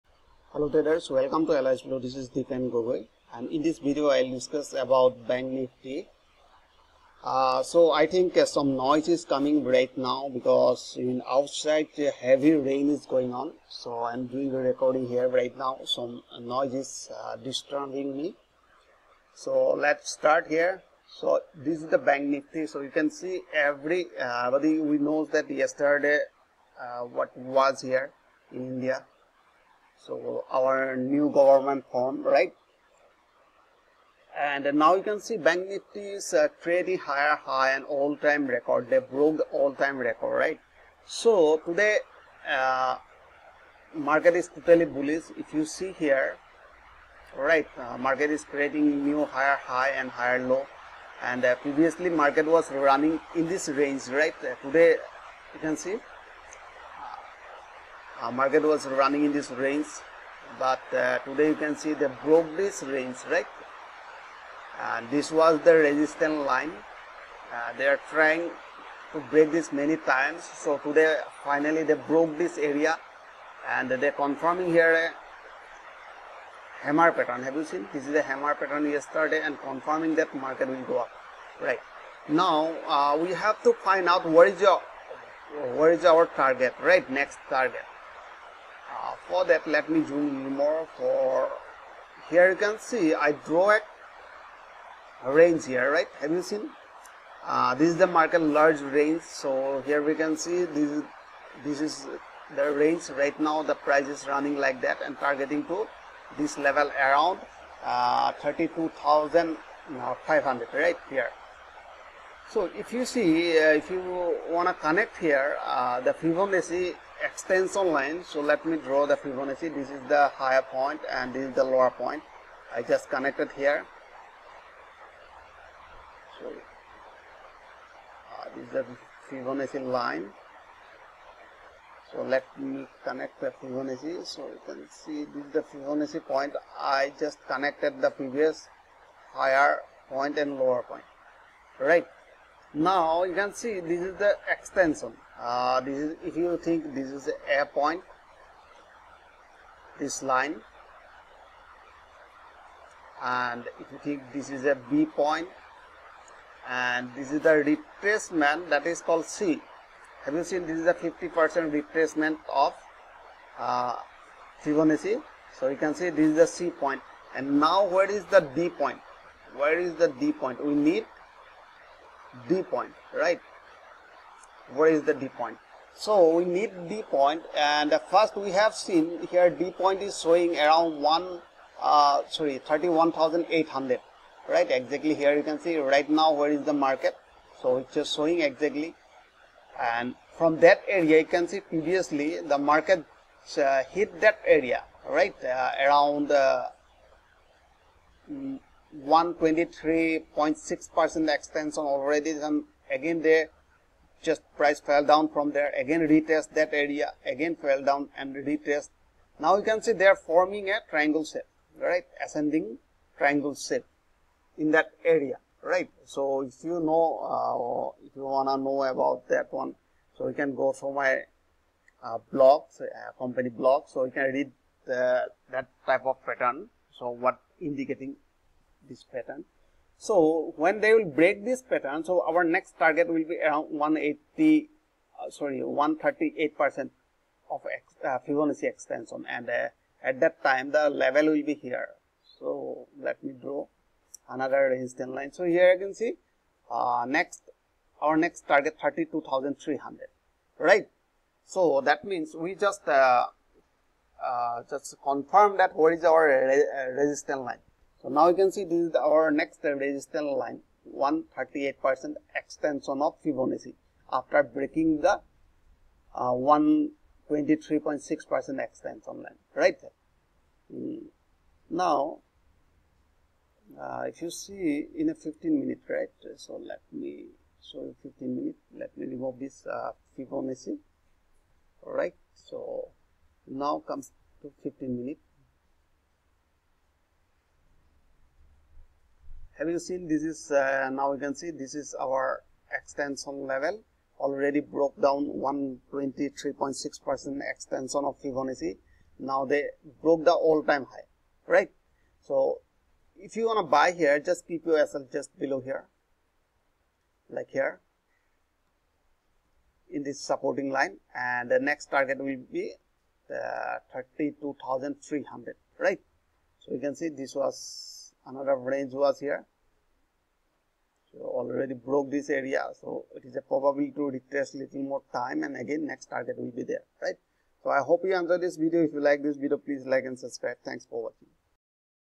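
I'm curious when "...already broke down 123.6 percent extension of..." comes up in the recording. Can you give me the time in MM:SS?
04:54.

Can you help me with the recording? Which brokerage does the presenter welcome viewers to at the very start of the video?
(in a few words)
Alice Blue.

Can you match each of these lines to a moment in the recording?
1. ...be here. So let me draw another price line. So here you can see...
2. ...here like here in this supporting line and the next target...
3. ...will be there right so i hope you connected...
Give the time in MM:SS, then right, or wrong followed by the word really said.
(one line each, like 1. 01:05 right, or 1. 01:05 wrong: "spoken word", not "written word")
1. 04:01 wrong: "resistance", not "price"
2. 05:05 right
3. 05:26 wrong: "enjoyed", not "connected".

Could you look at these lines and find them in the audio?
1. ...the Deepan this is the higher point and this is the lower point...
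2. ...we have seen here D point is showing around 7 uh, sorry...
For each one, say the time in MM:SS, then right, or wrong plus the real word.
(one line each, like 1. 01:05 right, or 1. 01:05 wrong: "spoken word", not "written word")
1. 01:59 wrong: "Fibonacci", not "Deepan"
2. 02:58 wrong: "1", not "7".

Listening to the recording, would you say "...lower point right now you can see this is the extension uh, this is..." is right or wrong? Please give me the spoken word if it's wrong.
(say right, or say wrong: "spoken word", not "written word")
right.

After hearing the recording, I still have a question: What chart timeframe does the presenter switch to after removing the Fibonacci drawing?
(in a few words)
15 minutes.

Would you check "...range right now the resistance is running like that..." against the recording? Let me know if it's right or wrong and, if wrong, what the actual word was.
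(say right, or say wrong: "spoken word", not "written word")
wrong: "price", not "resistance".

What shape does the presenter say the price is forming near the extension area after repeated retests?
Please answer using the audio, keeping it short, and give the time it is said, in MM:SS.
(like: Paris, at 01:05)
ascending triangle, at 03:32.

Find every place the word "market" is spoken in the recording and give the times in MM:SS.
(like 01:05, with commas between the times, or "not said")
00:43, 00:47, 00:52, 00:58, 01:20, 01:38, 03:06, 03:12.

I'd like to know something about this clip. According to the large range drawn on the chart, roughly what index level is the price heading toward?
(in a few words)
32,500.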